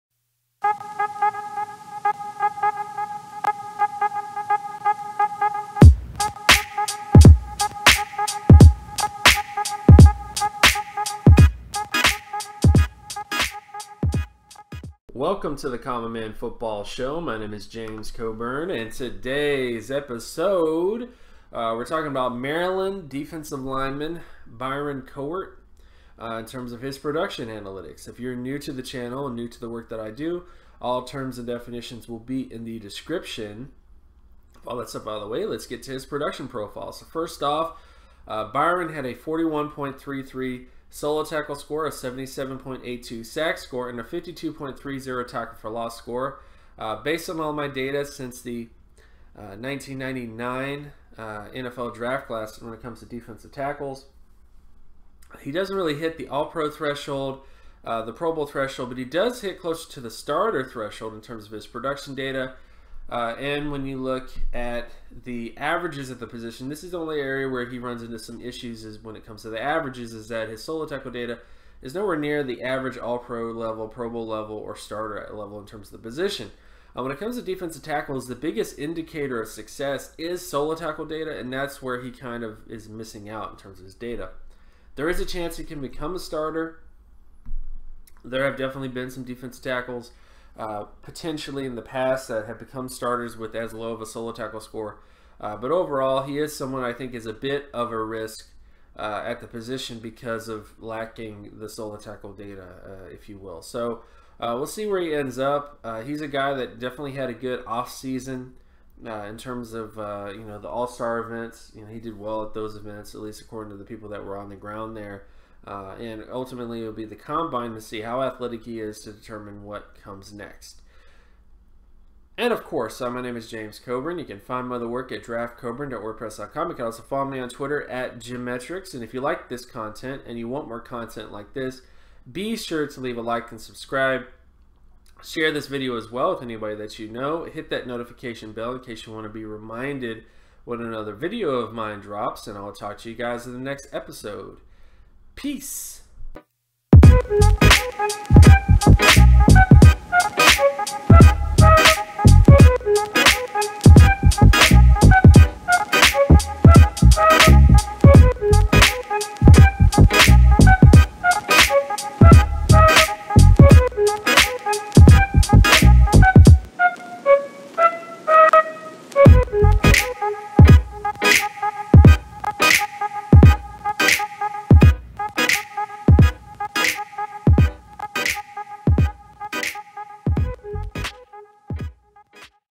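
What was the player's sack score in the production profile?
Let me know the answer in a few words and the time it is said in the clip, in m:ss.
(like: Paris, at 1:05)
77.82, at 0:41.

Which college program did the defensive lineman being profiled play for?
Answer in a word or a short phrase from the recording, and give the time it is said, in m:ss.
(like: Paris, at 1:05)
Maryland, at 0:22.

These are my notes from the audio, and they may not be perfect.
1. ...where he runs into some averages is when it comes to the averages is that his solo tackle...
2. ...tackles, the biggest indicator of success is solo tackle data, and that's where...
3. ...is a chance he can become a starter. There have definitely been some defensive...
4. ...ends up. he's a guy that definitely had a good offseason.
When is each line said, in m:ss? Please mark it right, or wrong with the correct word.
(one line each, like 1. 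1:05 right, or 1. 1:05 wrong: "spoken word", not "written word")
1. 1:07 wrong: "issues", not "averages"
2. 1:17 right
3. 1:25 right
4. 1:45 right.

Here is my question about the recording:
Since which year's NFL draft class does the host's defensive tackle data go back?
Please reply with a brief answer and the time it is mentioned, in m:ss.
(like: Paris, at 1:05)
1999, at 0:49.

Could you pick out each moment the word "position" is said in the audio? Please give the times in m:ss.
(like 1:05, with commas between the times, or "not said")
1:06, 1:16, 1:39.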